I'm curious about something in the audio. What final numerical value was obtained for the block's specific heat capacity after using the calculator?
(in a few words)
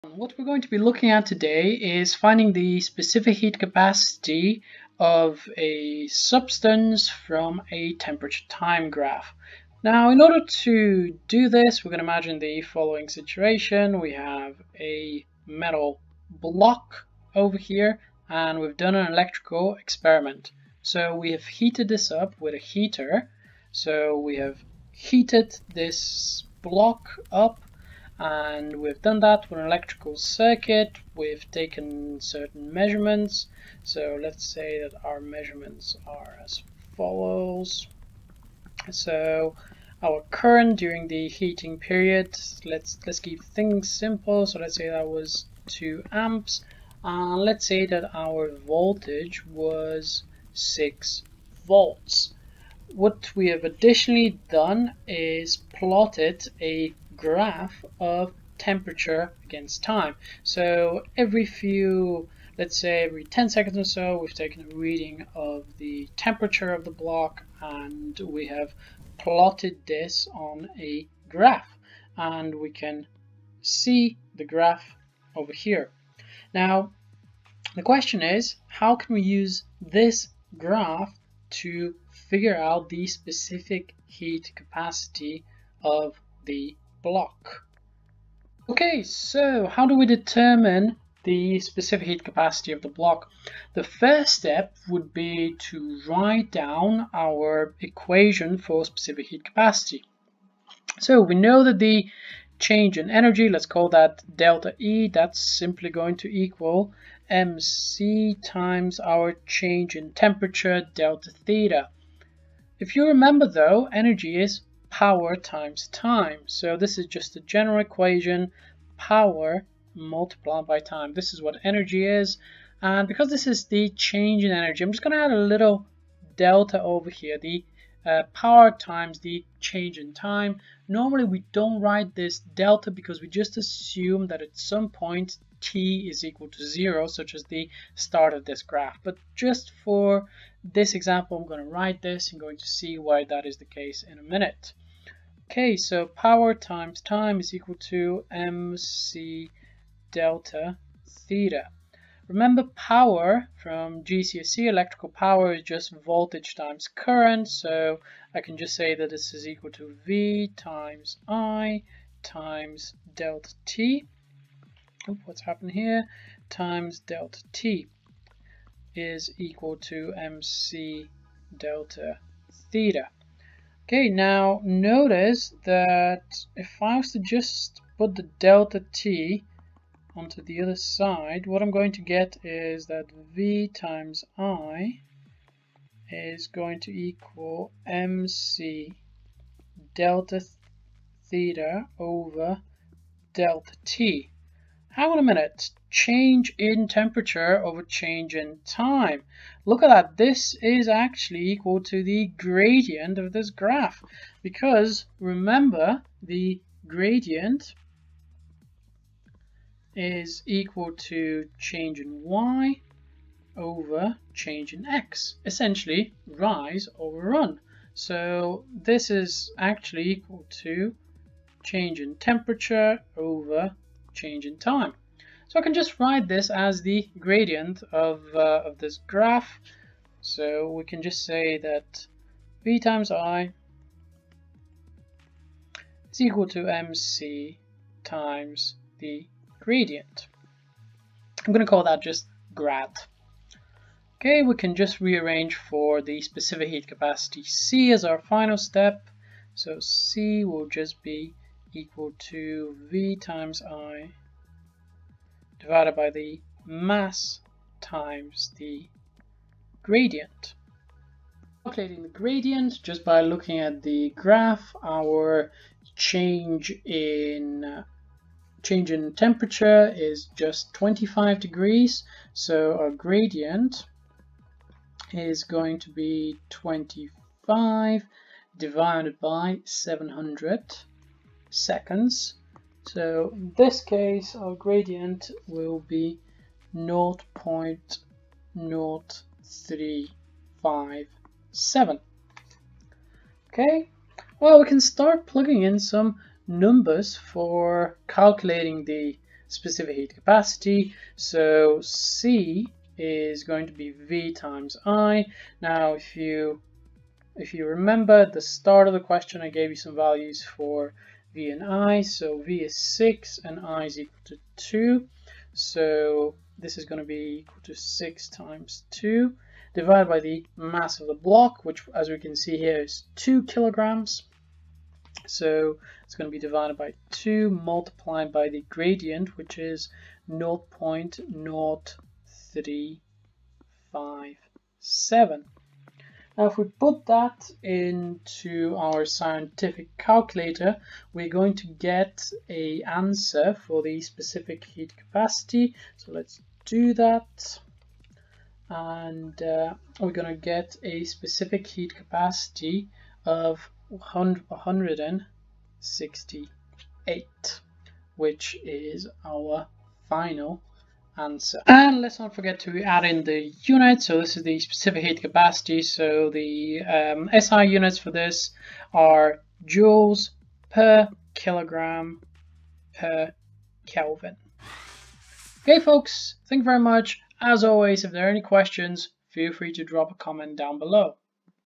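168.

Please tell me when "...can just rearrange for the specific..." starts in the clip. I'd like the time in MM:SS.
04:04.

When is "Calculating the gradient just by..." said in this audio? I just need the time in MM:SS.
04:21.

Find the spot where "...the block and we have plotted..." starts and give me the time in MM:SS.
01:06.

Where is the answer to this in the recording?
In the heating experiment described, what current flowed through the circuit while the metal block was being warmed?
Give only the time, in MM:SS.
00:45.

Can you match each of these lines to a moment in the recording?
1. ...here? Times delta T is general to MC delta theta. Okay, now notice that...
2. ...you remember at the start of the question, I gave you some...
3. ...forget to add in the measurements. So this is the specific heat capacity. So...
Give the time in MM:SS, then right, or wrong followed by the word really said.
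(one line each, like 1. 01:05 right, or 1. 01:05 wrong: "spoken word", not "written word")
1. 02:45 wrong: "equal", not "general"
2. 05:07 right
3. 06:02 wrong: "units", not "measurements".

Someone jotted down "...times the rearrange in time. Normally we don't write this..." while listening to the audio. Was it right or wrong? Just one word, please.
wrong.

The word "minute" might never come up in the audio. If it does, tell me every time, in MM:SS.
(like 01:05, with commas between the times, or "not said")
02:24, 03:15.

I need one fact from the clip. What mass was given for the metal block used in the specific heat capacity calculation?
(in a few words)
2 kilograms.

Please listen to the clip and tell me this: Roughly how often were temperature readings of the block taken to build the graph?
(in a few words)
every 10 seconds.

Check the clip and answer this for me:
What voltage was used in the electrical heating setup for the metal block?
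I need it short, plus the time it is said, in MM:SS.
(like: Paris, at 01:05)
6 volts, at 00:50.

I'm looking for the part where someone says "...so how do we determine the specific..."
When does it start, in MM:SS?
01:29.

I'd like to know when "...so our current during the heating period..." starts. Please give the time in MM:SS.
00:38.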